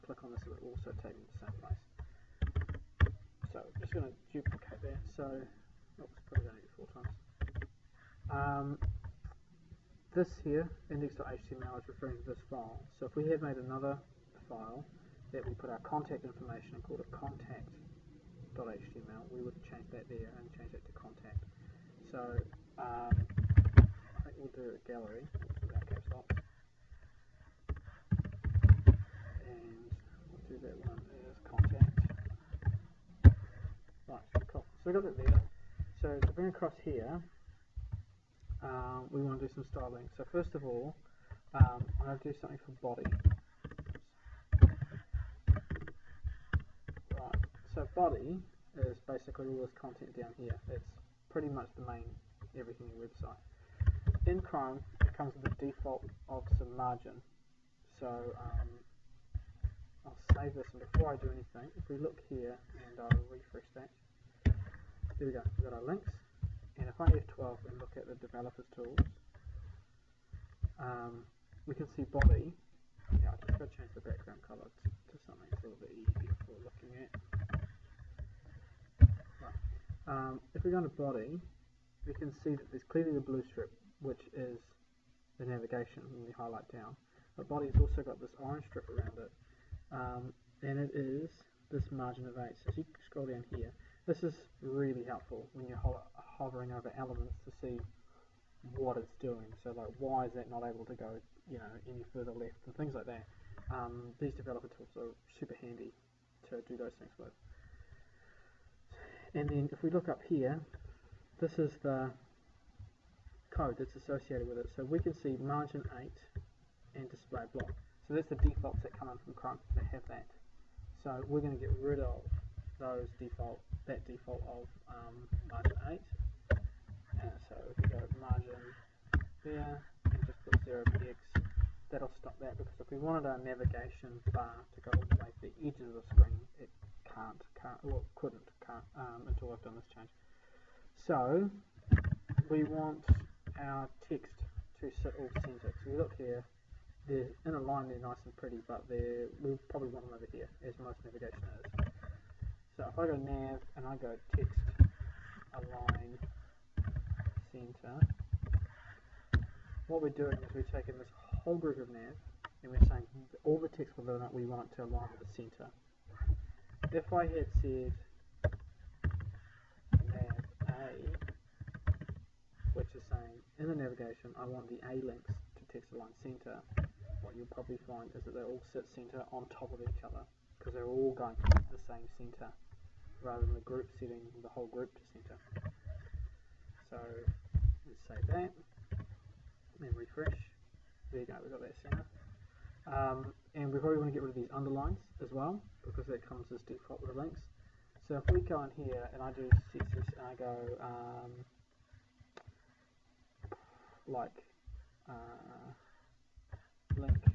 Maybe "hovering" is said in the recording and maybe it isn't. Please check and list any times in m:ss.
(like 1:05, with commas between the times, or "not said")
1:36.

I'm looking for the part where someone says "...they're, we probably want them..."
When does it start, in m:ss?
2:28.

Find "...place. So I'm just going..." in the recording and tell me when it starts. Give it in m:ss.
0:01.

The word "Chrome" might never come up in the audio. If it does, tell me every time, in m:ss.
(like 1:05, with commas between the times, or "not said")
0:54, 1:59.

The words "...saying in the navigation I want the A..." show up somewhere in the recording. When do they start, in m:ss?
2:53.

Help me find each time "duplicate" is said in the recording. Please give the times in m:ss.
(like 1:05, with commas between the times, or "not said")
0:04.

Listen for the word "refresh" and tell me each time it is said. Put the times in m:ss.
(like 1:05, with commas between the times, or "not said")
1:03, 3:09.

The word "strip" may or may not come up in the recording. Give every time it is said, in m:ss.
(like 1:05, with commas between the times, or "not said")
1:23, 1:28.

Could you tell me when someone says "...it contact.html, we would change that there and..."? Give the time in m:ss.
0:16.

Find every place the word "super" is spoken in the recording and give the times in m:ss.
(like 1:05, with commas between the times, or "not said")
1:45.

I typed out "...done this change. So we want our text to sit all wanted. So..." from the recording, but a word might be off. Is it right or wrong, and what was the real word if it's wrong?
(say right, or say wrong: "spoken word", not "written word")
wrong: "centered", not "wanted".